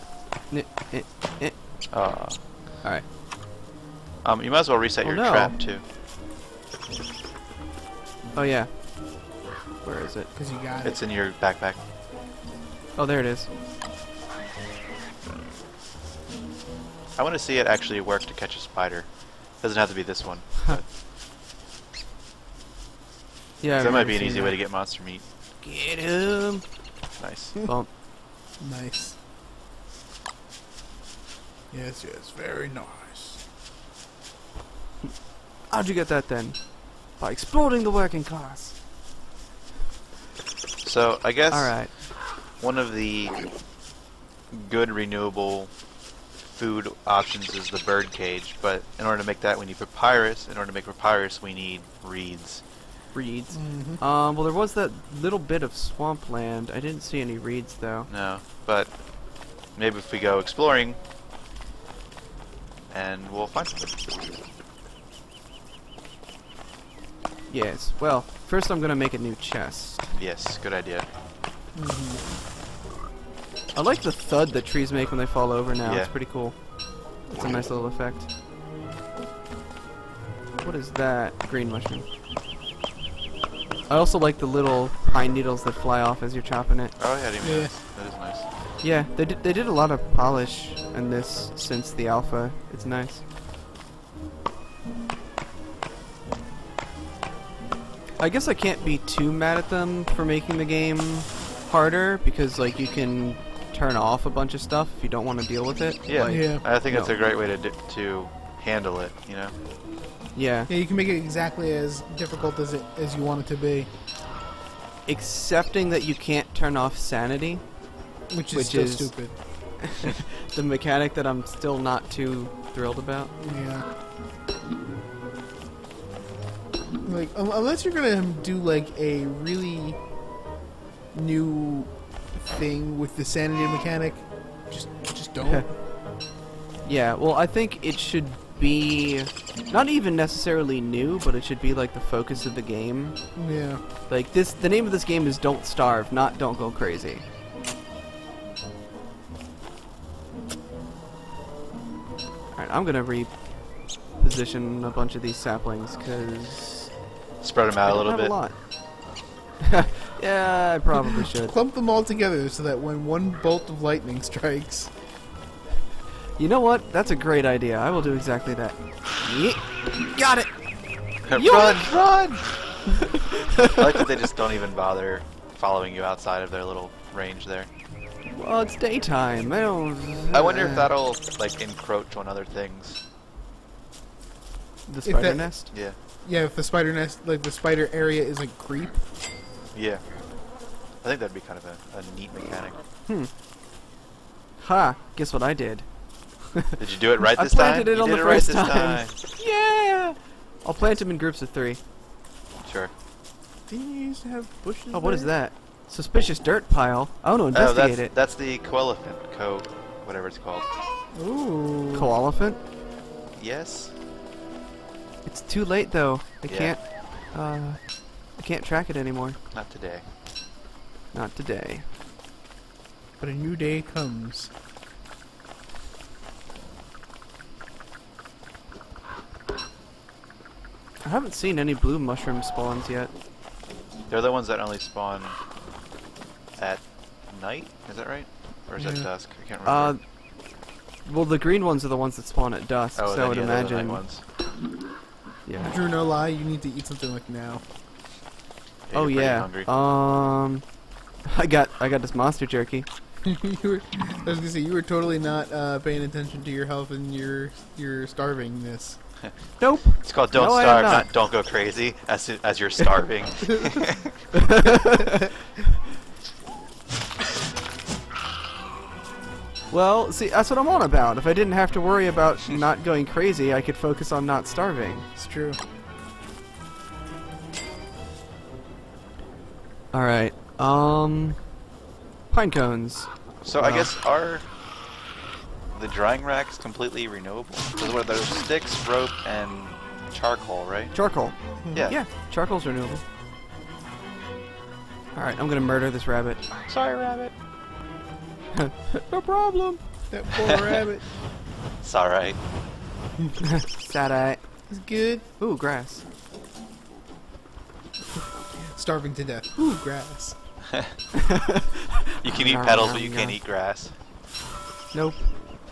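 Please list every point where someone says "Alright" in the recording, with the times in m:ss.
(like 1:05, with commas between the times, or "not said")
0:02, 2:32, 4:39.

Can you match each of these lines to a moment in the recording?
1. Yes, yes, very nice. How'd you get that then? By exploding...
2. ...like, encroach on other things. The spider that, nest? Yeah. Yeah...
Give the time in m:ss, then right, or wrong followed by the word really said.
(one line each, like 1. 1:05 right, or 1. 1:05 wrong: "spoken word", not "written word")
1. 0:31 right
2. 3:01 right.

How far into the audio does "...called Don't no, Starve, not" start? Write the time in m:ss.
4:20.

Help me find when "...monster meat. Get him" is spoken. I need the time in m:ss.
0:24.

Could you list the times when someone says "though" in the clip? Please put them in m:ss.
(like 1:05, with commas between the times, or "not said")
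0:57, 3:35.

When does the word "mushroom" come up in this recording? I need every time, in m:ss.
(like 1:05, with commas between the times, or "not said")
1:21, 3:51.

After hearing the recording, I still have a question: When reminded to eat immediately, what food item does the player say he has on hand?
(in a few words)
Monster jerky.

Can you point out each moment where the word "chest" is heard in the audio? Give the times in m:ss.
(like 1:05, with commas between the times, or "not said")
1:09.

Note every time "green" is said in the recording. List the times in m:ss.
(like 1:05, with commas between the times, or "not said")
1:21, 4:01.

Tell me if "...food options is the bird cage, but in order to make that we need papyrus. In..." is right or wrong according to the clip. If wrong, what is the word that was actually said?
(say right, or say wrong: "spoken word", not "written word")
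right.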